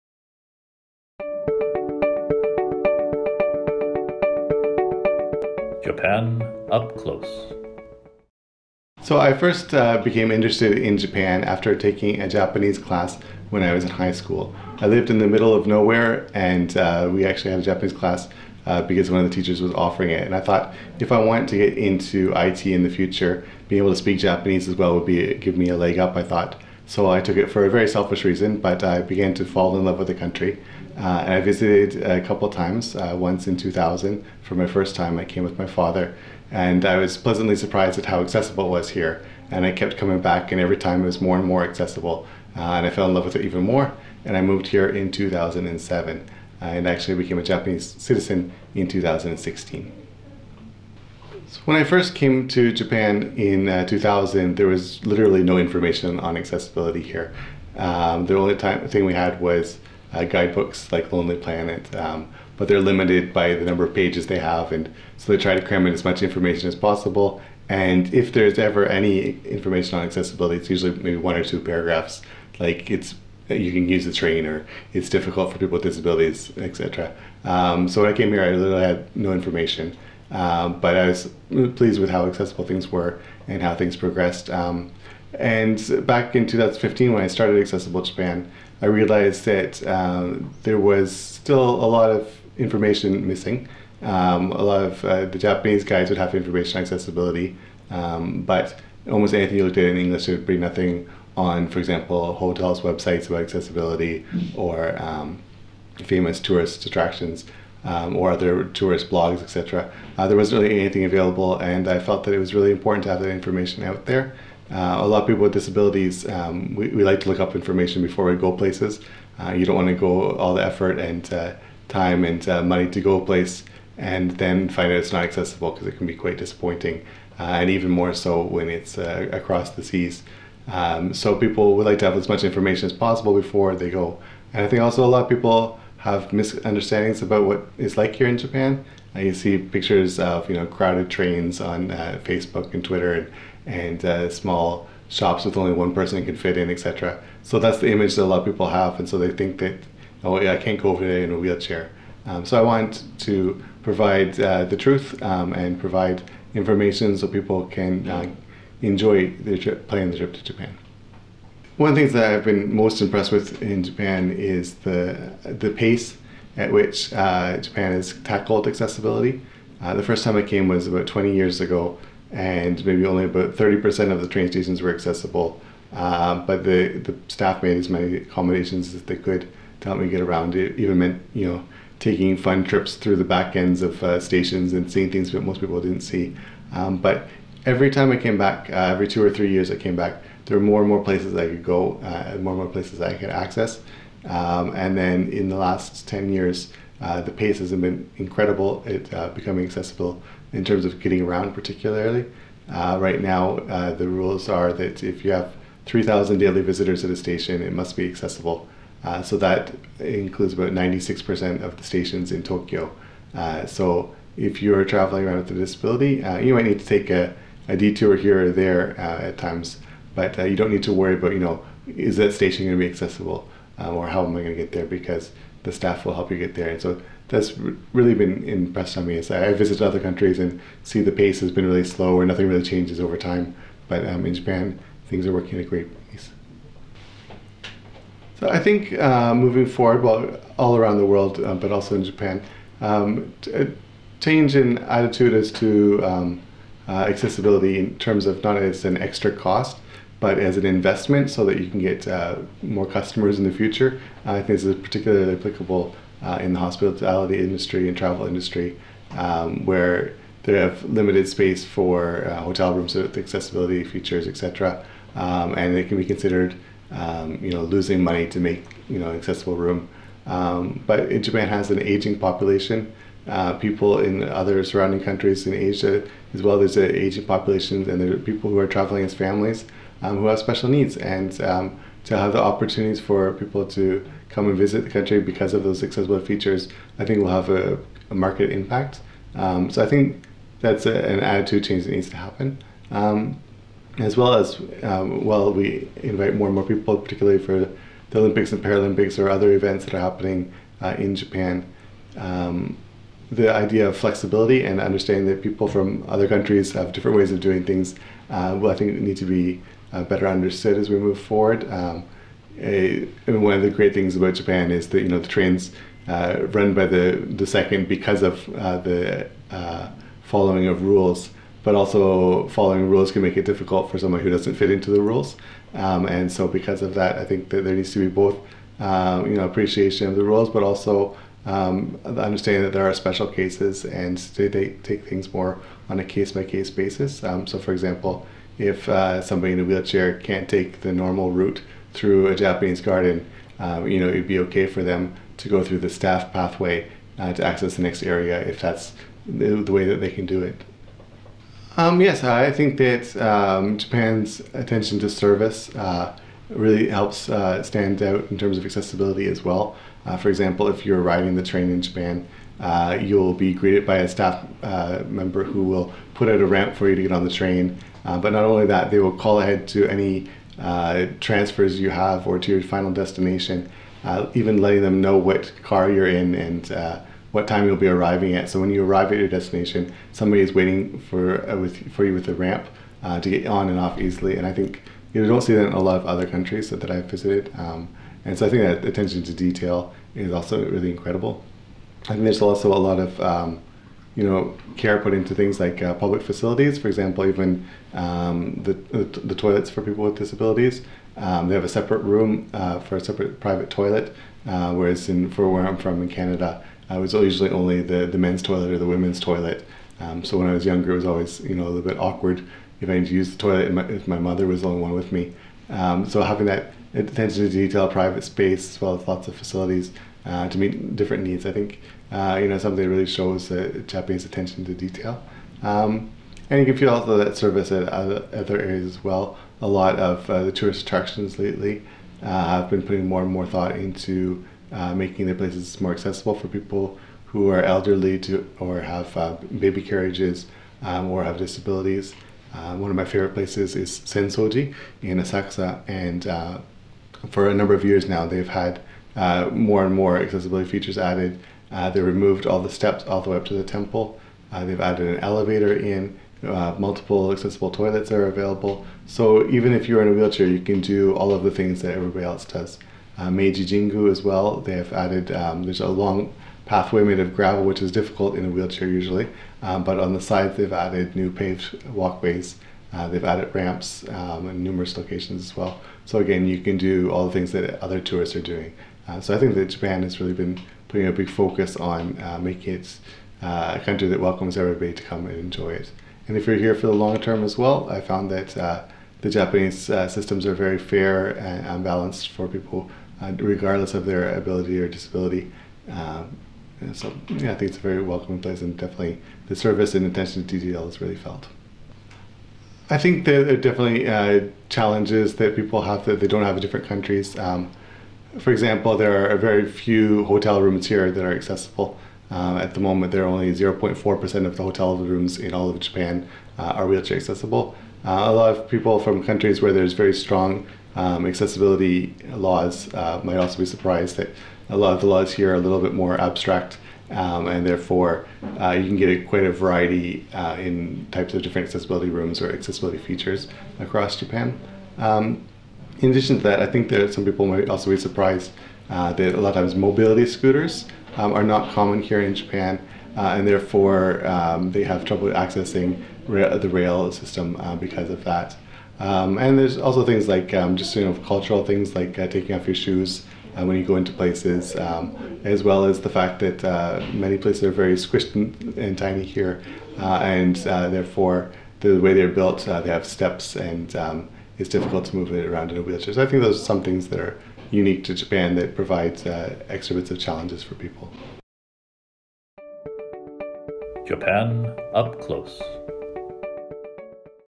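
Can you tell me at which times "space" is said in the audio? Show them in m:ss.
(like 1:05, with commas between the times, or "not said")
4:21, 6:58.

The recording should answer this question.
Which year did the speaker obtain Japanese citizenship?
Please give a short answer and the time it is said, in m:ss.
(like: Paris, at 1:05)
2016, at 0:48.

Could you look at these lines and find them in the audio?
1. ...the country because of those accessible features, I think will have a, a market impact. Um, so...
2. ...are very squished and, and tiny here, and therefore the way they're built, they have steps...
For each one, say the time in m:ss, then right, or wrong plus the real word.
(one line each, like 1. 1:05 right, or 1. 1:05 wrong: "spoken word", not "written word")
1. 4:44 right
2. 9:17 right.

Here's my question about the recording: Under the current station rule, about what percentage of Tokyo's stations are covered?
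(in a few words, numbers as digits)
96%.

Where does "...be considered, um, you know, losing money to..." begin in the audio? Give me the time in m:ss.
4:25.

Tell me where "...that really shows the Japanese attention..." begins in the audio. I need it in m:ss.
7:02.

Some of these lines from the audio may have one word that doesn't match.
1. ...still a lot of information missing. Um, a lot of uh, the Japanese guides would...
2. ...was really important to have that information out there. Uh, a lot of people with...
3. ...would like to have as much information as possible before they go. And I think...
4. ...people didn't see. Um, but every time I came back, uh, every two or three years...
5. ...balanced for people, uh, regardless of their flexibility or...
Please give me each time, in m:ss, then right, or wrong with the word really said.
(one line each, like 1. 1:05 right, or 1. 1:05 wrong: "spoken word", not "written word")
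1. 1:31 right
2. 1:52 right
3. 2:11 right
4. 3:05 right
5. 8:11 wrong: "ability", not "flexibility".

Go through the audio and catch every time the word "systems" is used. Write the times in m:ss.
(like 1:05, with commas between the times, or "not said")
8:10, 9:07.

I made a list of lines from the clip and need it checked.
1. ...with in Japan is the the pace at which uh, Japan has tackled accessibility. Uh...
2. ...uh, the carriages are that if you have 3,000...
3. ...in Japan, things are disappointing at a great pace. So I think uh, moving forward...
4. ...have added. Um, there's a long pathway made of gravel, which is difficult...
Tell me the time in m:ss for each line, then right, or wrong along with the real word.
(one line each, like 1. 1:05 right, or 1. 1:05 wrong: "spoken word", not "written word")
1. 2:43 right
2. 3:23 wrong: "rules", not "carriages"
3. 3:54 wrong: "working", not "disappointing"
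4. 7:44 right.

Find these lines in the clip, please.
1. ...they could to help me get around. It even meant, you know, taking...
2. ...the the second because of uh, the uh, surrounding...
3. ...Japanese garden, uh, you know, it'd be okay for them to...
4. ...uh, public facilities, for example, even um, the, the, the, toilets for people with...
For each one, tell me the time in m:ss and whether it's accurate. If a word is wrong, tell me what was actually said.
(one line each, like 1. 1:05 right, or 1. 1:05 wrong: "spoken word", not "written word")
1. 2:59 right
2. 5:16 wrong: "following", not "surrounding"
3. 5:42 right
4. 6:35 right.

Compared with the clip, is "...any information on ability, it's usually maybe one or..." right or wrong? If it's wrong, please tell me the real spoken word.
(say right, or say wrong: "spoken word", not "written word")
wrong: "accessibility", not "ability".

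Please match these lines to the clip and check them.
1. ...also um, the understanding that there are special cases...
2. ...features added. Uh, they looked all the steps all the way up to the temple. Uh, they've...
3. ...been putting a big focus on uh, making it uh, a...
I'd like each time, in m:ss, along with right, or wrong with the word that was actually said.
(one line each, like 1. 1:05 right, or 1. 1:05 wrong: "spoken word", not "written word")
1. 5:30 right
2. 7:30 wrong: "removed", not "looked"
3. 8:00 right.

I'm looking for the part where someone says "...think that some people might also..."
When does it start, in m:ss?
8:56.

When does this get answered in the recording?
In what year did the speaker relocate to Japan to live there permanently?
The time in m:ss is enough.
0:45.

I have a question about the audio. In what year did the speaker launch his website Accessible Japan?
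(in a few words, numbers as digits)
2015.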